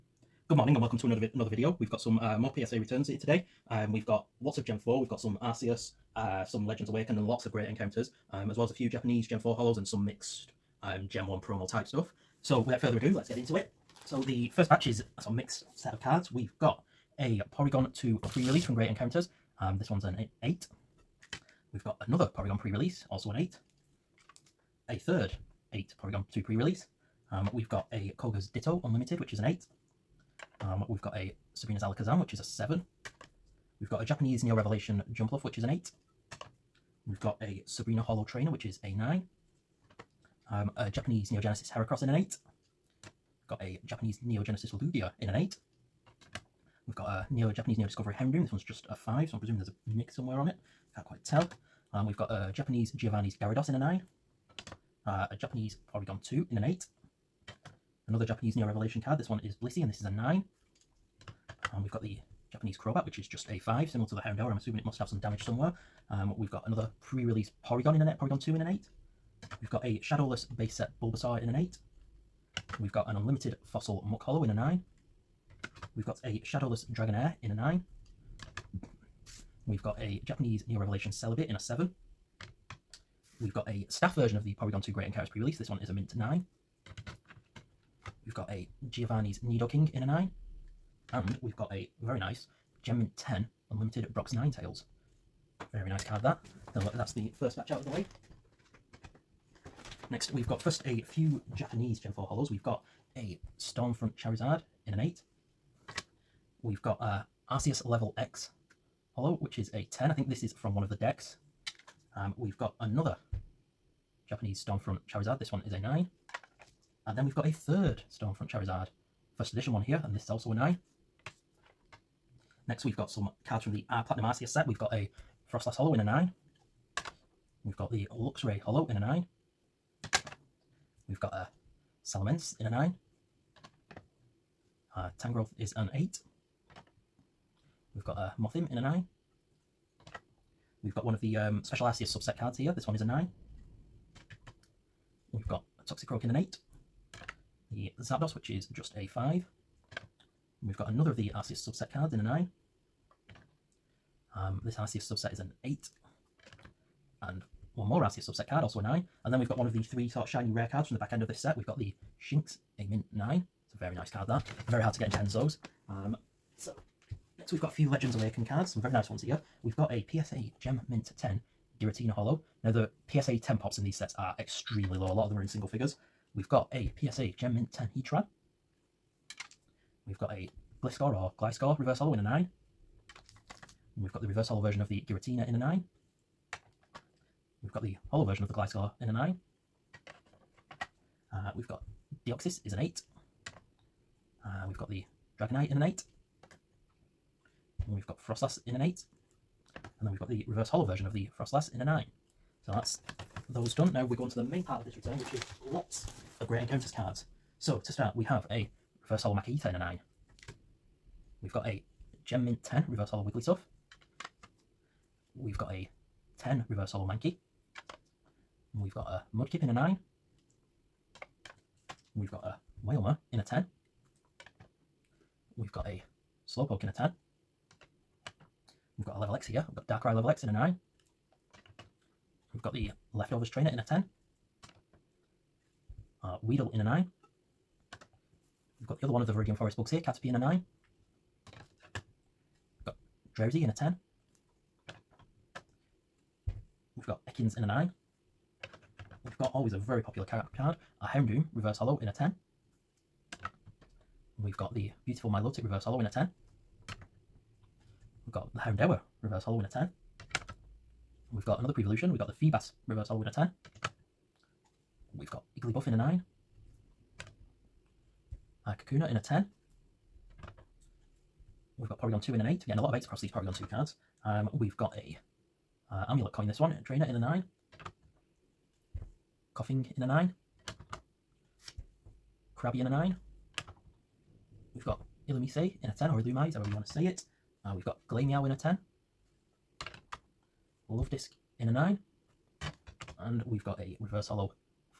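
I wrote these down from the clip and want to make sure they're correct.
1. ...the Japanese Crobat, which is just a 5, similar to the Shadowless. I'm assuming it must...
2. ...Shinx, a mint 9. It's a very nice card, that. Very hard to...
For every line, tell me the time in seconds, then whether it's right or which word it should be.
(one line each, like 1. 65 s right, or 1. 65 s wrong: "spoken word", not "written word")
1. 62 s wrong: "Houndour", not "Shadowless"
2. 162 s right.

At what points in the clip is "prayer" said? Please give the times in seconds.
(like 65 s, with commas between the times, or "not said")
not said.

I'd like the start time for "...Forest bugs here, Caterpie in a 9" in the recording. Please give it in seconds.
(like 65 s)
239 s.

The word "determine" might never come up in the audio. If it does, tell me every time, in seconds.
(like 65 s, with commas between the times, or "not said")
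not said.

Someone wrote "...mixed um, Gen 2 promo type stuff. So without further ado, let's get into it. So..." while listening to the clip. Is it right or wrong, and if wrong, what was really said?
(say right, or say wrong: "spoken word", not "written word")
wrong: "1", not "2".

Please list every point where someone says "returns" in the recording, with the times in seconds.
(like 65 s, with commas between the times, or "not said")
2 s, 204 s.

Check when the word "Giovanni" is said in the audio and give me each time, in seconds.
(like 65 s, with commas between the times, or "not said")
52 s, 88 s.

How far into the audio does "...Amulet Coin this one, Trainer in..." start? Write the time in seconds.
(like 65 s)
276 s.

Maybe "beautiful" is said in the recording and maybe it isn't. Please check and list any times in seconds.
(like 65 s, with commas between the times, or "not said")
255 s.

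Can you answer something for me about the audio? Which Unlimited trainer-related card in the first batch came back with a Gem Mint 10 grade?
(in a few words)
Brock's Tails.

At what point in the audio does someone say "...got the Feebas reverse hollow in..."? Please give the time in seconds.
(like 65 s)
262 s.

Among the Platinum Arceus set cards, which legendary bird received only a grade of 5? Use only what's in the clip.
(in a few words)
Zapdos.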